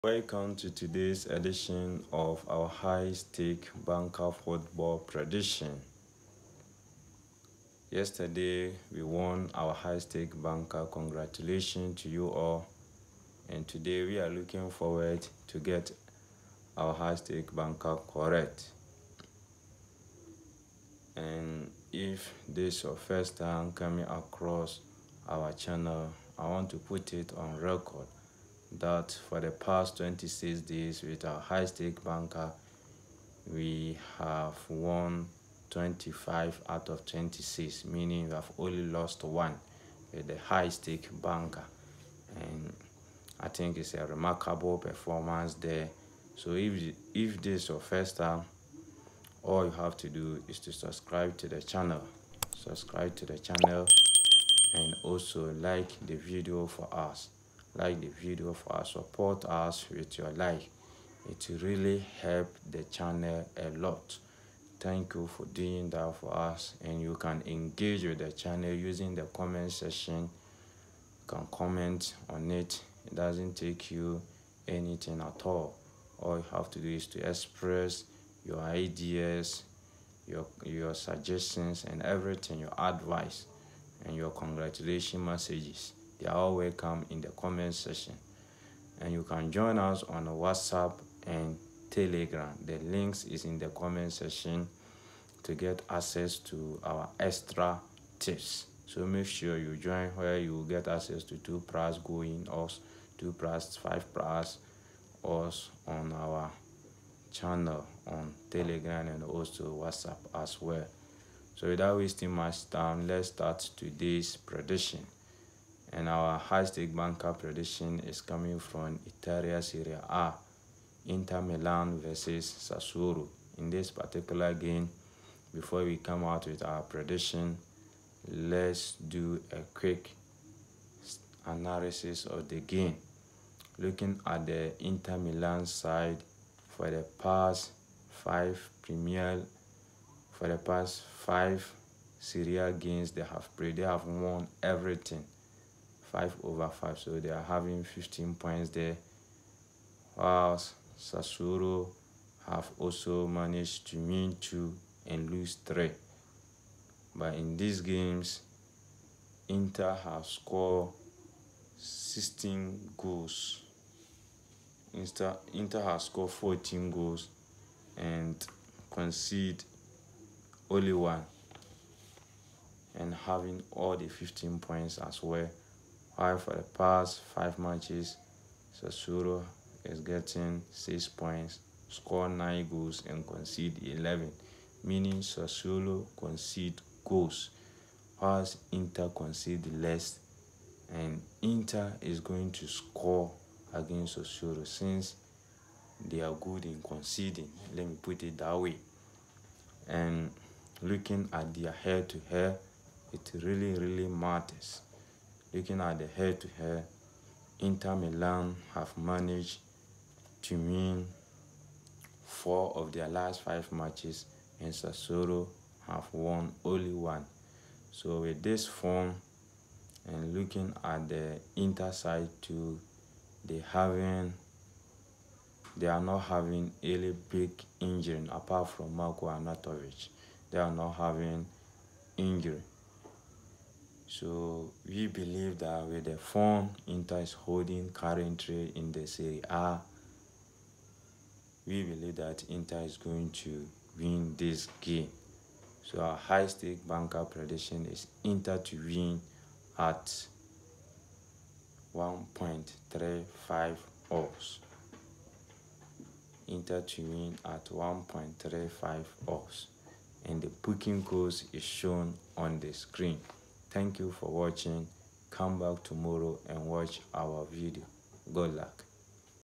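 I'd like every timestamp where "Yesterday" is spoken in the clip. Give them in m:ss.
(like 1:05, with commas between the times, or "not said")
0:07.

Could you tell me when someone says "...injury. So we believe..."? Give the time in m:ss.
3:52.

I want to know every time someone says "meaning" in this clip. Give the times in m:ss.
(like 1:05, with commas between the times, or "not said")
0:37, 3:04.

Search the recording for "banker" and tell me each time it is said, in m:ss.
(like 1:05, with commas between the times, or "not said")
0:03, 0:10, 0:17, 0:32, 0:41, 1:56, 4:06.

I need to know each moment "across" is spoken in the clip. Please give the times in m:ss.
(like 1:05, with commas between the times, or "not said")
0:24.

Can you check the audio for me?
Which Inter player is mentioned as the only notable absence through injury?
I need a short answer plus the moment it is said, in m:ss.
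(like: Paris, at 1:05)
Marko Arnautović, at 3:48.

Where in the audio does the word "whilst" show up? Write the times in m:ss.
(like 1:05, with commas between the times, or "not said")
2:30, 3:08.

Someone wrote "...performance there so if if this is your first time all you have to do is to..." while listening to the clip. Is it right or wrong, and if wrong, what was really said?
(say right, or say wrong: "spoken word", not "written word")
right.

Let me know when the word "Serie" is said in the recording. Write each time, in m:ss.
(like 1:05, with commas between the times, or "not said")
1:59, 2:22, 3:59.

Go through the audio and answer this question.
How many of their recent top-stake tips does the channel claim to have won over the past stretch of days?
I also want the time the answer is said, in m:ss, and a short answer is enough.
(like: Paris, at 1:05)
25, at 0:35.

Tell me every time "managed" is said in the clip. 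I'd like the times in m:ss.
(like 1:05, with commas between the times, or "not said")
2:33, 3:28.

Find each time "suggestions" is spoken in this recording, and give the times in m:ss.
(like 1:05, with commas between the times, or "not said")
1:20.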